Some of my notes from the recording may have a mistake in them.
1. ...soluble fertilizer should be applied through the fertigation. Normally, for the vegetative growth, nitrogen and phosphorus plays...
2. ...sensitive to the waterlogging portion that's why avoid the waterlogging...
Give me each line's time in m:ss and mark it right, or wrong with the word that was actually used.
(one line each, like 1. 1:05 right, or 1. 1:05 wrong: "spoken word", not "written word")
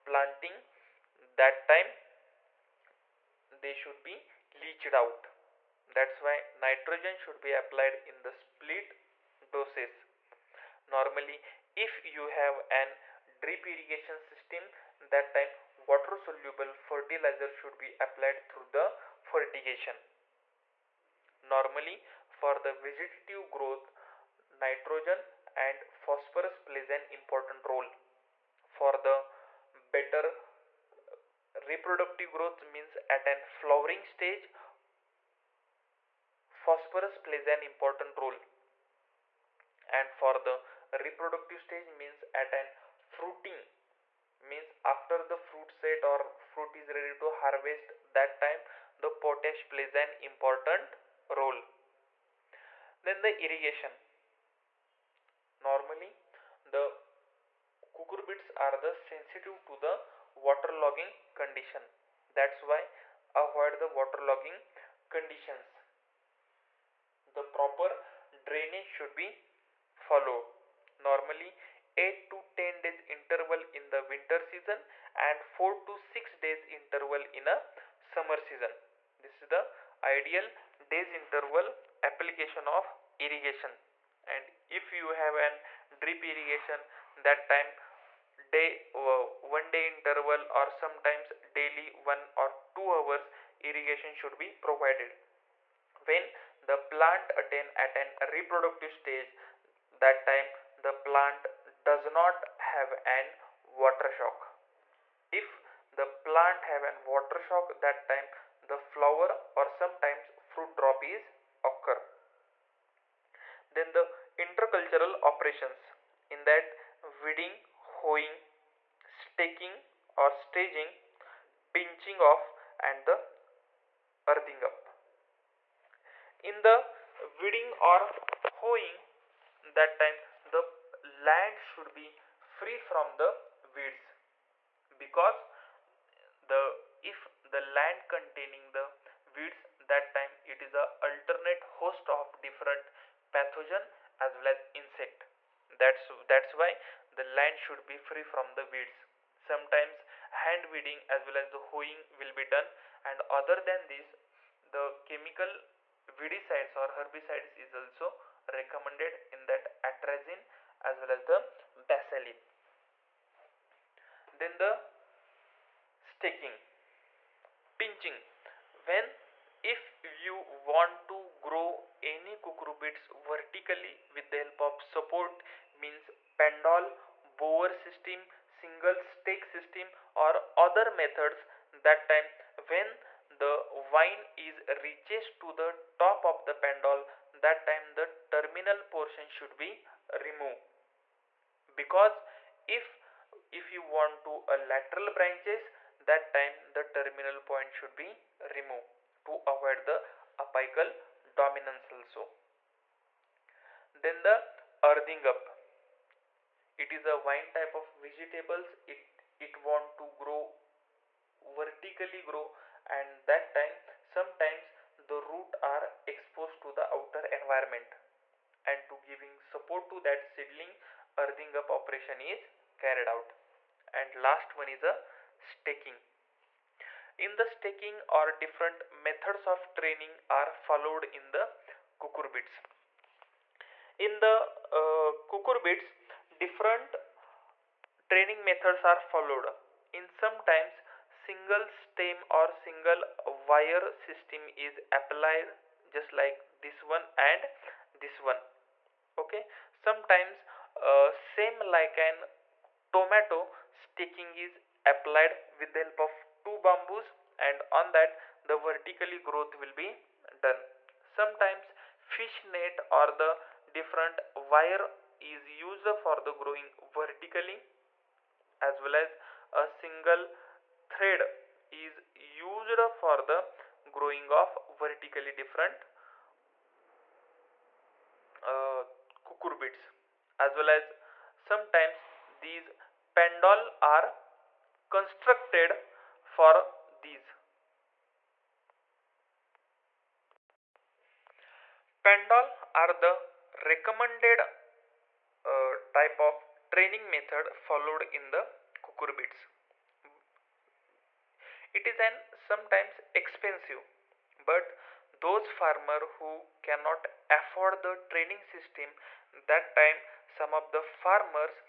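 1. 0:16 right
2. 0:58 wrong: "condition", not "portion".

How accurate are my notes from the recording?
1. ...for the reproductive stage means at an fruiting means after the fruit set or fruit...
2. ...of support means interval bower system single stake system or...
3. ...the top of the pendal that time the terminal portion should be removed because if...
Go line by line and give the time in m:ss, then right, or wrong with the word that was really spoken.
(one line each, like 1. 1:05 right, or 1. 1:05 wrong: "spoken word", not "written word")
1. 0:40 right
2. 2:54 wrong: "pendal", not "interval"
3. 3:05 right.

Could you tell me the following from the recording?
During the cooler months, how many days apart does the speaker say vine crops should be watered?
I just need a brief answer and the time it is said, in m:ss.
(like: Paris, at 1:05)
8 to 10 days, at 1:11.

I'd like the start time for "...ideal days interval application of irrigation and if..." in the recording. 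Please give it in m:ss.
1:20.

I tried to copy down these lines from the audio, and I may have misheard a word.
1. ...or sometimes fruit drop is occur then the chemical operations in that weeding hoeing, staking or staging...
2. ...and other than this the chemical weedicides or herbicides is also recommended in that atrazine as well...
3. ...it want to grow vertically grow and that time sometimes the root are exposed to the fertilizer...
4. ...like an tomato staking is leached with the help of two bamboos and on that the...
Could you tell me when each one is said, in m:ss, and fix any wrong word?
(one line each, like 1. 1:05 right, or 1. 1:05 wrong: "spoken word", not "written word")
1. 1:49 wrong: "intercultural", not "chemical"
2. 2:33 right
3. 3:29 wrong: "outer", not "fertilizer"
4. 4:11 wrong: "applied", not "leached".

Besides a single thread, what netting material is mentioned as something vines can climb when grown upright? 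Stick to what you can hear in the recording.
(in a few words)
fish net.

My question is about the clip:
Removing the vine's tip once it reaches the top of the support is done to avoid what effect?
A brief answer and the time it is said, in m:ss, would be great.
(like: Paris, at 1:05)
apical dominance, at 3:20.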